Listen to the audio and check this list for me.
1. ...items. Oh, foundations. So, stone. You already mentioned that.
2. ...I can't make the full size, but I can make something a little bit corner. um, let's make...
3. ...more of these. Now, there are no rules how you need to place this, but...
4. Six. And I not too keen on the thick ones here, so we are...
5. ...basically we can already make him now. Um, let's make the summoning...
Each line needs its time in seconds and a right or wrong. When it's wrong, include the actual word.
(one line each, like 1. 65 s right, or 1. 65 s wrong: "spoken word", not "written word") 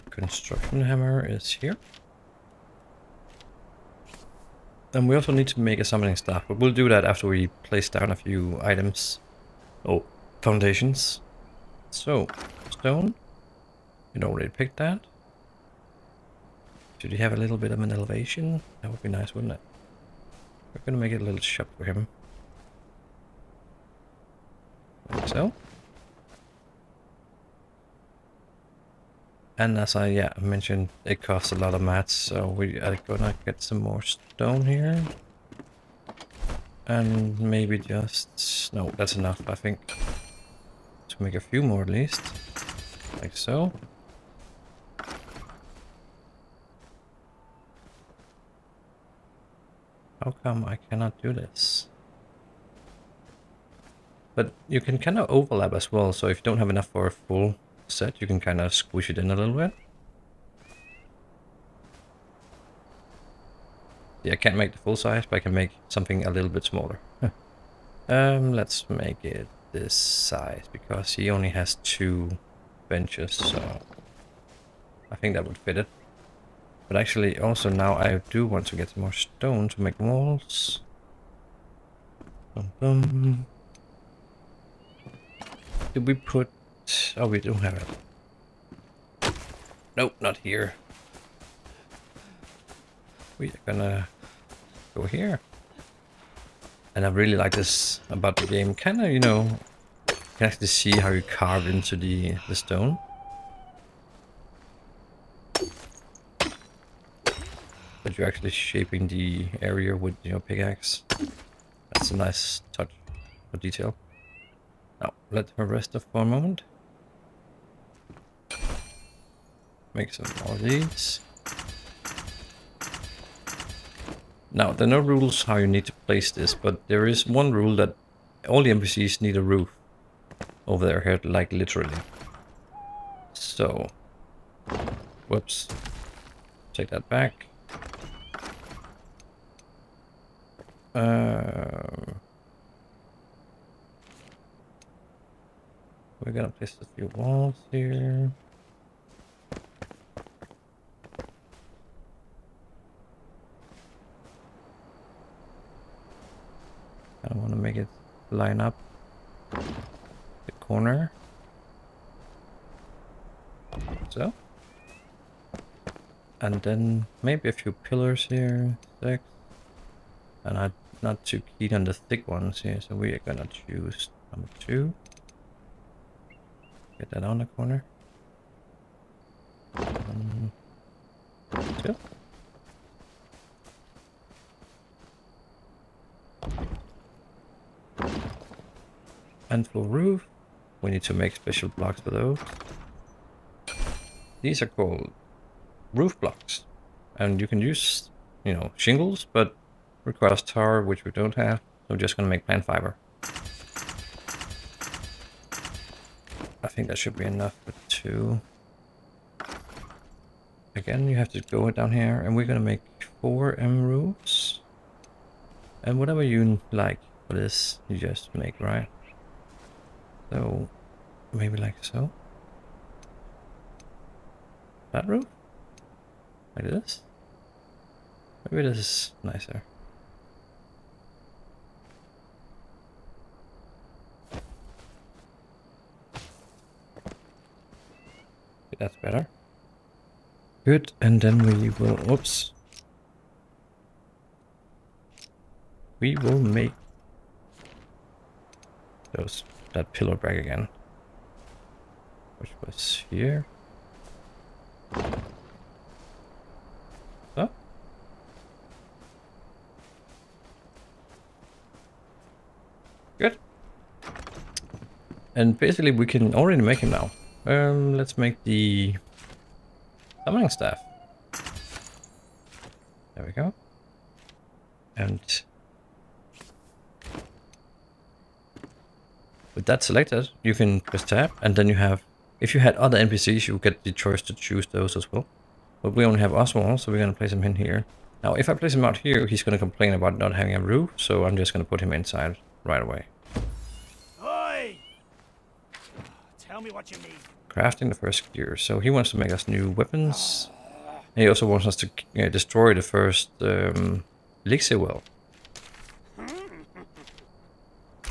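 1. 8 s wrong: "picked", not "mentioned"
2. 64 s wrong: "smaller", not "corner"
3. 120 s right
4. 169 s right
5. 265 s right.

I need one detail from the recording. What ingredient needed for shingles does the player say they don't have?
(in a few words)
Tar.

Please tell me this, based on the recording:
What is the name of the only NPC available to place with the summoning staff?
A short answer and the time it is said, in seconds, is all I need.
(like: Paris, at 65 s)
Oswald, at 286 s.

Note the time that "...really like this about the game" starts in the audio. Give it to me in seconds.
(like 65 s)
97 s.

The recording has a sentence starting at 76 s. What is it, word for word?
But actually, also now I do want to get more stone to make walls.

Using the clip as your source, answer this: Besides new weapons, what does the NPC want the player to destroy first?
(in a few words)
Elixir well.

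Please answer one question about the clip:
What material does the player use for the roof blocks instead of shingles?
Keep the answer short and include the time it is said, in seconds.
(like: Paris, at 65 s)
Plant fiber, at 202 s.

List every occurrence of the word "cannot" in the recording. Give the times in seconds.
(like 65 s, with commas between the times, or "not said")
50 s.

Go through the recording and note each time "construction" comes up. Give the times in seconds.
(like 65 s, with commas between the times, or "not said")
0 s.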